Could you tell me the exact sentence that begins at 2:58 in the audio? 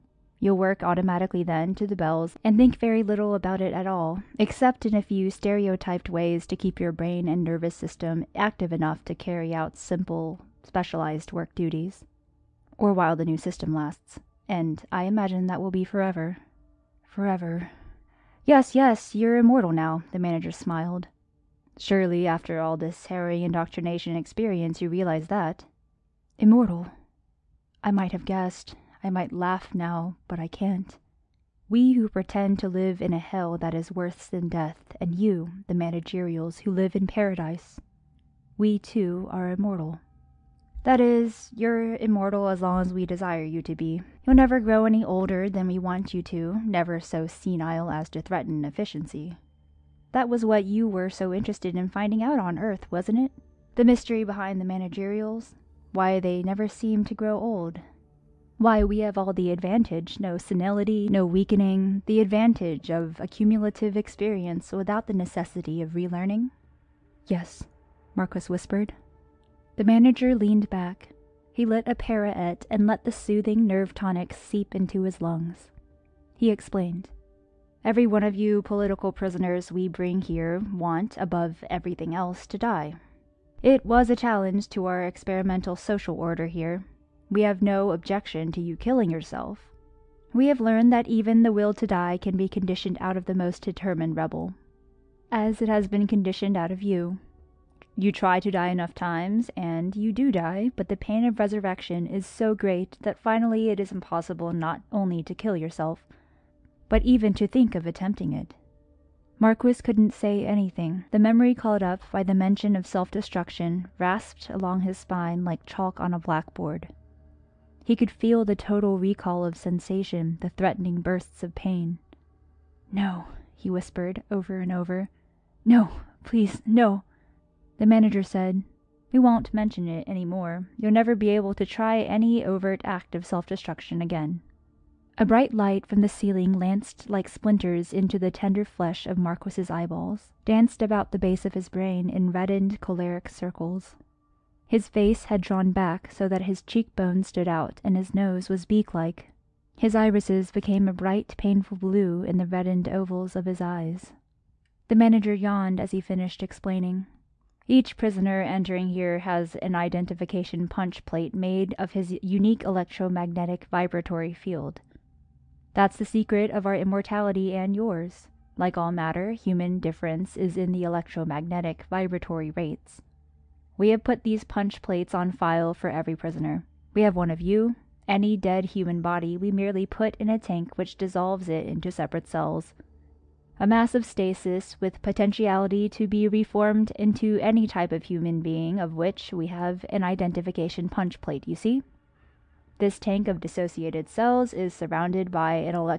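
Any dead human body we merely put in a tank which dissolves it into separate cells.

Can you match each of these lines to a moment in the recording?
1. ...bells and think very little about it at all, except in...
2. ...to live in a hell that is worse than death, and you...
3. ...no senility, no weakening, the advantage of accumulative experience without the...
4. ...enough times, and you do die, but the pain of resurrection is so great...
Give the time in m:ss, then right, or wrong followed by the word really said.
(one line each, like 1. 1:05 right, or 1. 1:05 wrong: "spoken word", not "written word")
1. 0:01 right
2. 0:32 right
3. 1:00 right
4. 1:38 right.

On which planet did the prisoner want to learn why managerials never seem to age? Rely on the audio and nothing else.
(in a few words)
Earth.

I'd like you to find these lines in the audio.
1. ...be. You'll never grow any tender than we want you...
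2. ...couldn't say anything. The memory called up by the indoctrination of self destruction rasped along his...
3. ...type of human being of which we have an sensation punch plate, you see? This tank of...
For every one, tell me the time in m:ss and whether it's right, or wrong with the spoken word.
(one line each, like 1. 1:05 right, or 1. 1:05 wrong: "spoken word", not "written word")
1. 0:43 wrong: "older", not "tender"
2. 1:49 wrong: "mention", not "indoctrination"
3. 3:07 wrong: "identification", not "sensation".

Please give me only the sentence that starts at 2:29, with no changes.
His irises became a bright, painful blue in the reddened ovals of his eyes.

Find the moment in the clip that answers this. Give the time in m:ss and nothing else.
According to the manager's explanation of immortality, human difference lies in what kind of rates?
2:50.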